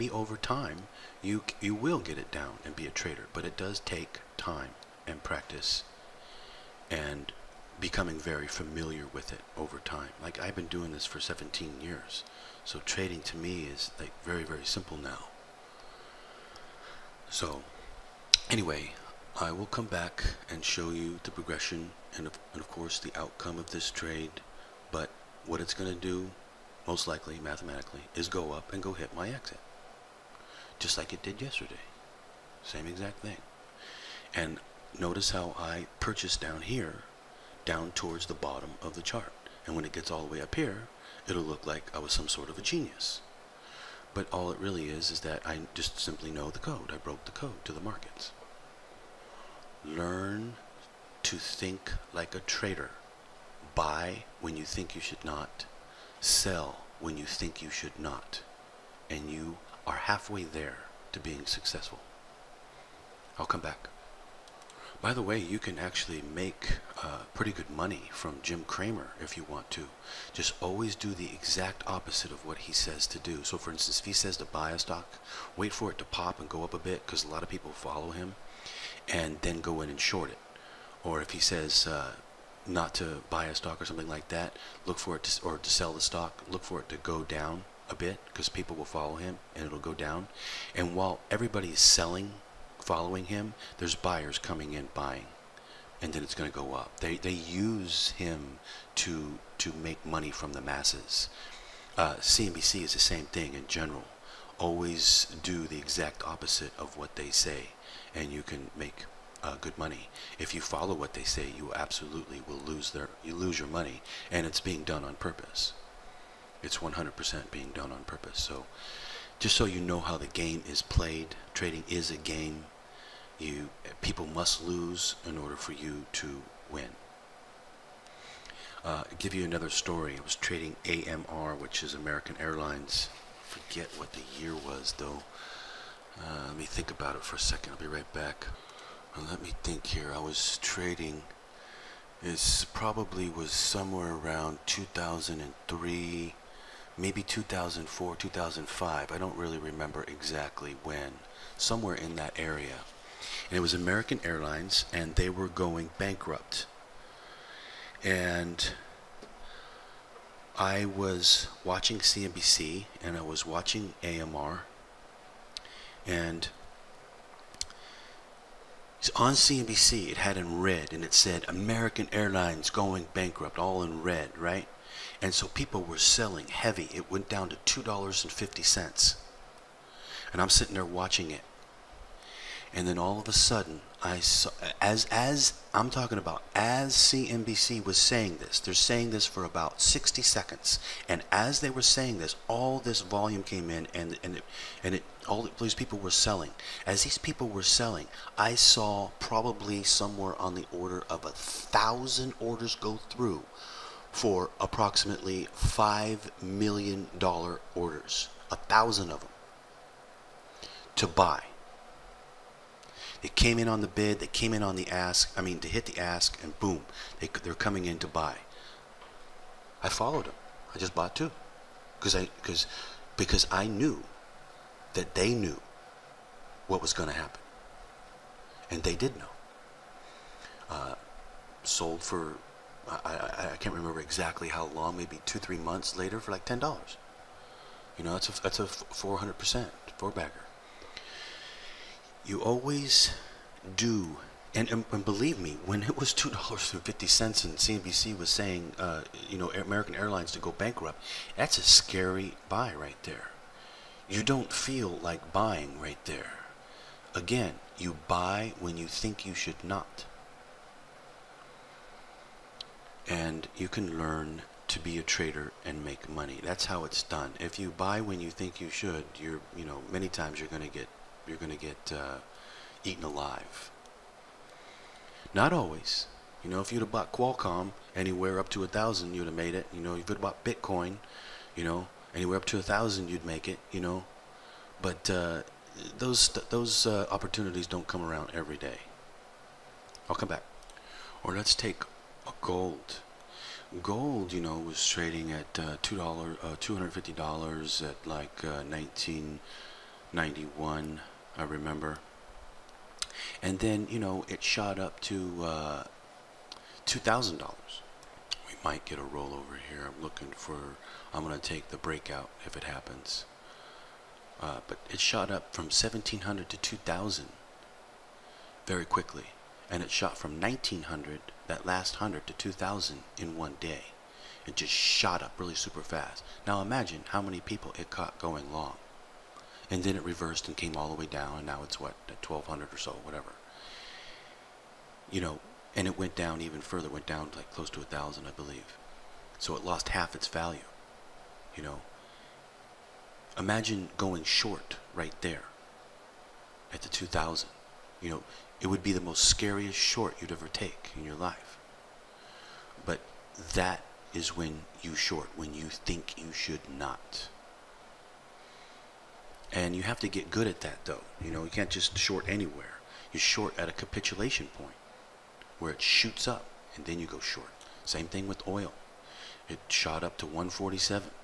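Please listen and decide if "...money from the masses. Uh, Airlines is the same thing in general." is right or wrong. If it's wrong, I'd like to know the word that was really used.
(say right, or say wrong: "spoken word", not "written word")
wrong: "CNBC", not "Airlines".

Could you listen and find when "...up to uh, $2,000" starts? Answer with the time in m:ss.
5:04.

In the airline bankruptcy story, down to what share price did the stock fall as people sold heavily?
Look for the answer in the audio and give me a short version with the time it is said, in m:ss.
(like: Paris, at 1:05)
$2.50, at 2:57.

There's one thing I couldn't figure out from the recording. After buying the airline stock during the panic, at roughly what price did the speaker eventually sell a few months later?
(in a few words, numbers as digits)
$10.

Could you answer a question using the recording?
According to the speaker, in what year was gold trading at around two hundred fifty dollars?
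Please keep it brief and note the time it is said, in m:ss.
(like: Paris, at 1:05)
1991, at 4:58.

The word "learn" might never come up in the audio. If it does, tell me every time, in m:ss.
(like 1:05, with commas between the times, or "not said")
0:49, 4:23.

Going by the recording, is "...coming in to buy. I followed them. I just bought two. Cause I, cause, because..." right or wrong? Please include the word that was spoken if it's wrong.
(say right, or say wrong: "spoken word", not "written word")
right.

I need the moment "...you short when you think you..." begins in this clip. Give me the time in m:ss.
5:54.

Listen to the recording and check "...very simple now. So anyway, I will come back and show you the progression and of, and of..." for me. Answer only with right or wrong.
right.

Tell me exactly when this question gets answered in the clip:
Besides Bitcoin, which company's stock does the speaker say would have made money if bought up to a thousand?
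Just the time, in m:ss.
4:37.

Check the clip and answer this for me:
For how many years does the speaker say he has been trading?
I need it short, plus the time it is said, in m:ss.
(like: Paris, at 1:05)
17 years, at 0:11.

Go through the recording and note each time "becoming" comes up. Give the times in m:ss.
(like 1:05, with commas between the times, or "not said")
0:07.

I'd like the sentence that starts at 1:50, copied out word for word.
If you follow what they say, you absolutely will lose their you lose your money, and it's being done on purpose.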